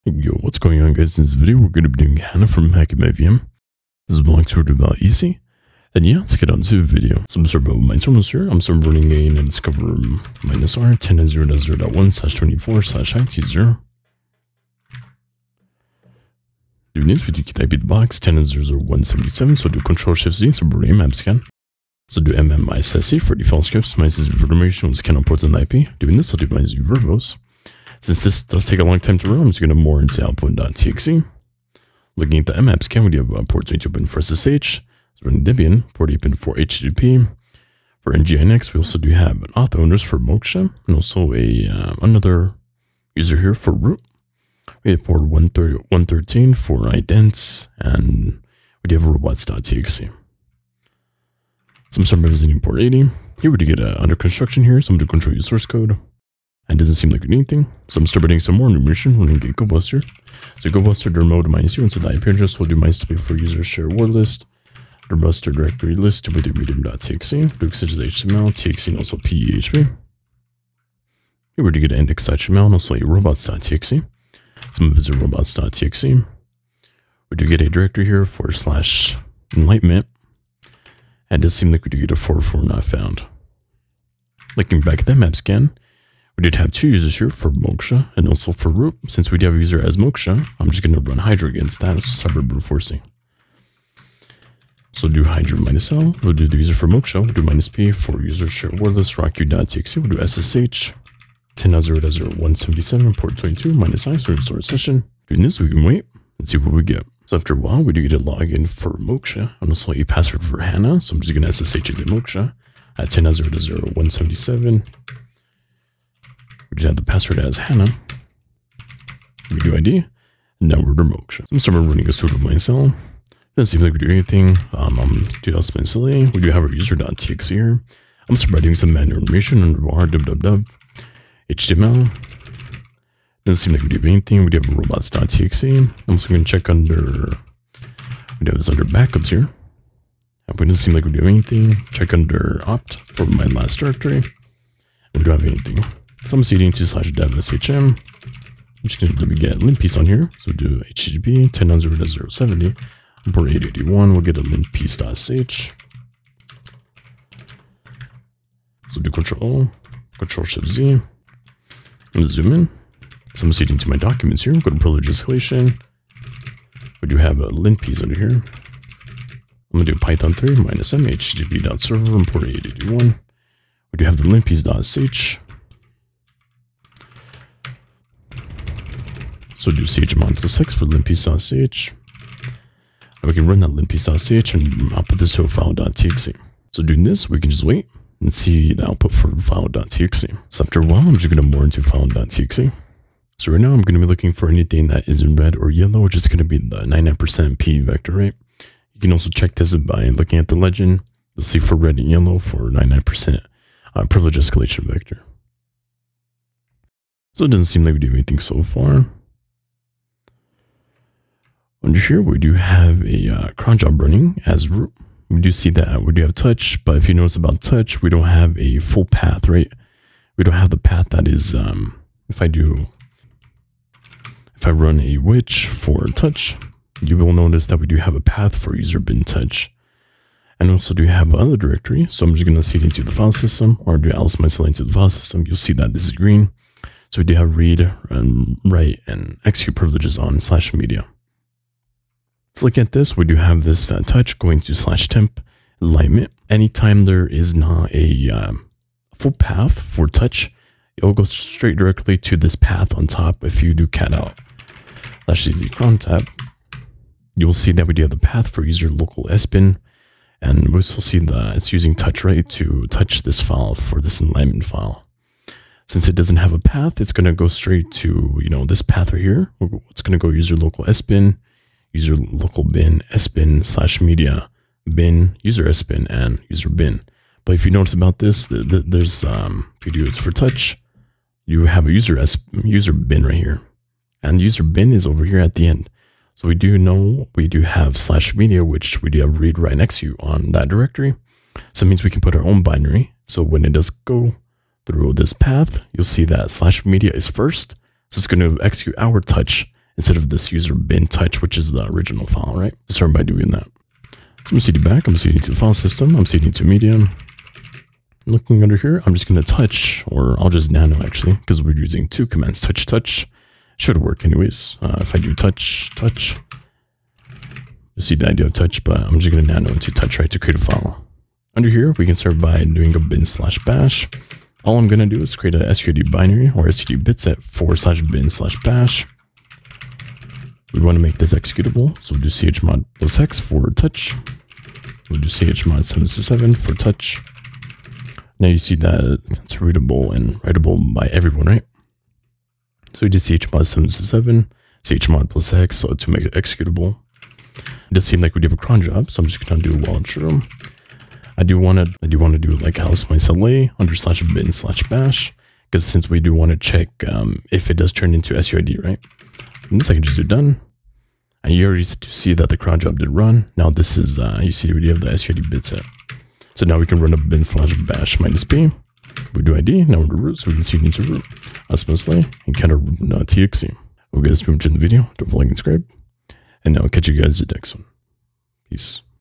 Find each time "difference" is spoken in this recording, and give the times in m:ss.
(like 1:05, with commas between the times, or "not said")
not said.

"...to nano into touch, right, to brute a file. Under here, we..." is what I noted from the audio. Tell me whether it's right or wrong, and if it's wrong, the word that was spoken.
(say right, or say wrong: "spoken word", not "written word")
wrong: "create", not "brute".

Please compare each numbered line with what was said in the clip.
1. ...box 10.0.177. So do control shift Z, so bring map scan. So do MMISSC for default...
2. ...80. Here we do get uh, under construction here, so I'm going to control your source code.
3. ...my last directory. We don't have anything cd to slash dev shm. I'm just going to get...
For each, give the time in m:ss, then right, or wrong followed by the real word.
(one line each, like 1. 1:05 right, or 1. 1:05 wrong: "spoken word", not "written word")
1. 0:17 right
2. 0:52 right
3. 2:23 right.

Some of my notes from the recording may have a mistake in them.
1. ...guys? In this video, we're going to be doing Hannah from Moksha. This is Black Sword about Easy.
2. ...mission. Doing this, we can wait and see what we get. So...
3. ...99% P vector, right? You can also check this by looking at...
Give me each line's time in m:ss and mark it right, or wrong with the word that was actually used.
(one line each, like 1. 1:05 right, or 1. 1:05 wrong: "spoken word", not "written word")
1. 0:00 wrong: "HackMVM", not "Moksha"
2. 1:44 wrong: "session", not "mission"
3. 3:16 right.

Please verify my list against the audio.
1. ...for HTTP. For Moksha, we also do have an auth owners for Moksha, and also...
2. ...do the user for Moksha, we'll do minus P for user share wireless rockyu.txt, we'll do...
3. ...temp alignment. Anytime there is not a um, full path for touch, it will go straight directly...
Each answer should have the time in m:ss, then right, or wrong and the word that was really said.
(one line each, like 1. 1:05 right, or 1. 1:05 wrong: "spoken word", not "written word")
1. 0:36 wrong: "NGINX", not "Moksha"
2. 1:36 right
3. 4:05 right.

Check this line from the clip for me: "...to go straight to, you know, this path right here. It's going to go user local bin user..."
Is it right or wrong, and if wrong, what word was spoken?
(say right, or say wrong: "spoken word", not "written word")
right.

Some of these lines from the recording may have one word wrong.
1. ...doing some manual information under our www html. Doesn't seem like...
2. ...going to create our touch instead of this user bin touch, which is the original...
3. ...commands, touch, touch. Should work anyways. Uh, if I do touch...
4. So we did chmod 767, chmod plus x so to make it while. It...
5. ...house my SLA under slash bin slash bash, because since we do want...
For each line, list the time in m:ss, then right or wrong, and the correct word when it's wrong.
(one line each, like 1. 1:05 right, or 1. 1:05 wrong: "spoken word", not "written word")
1. 2:08 right
2. 4:58 wrong: "execute", not "create"
3. 5:12 right
4. 5:42 wrong: "executable", not "while"
5. 5:52 right.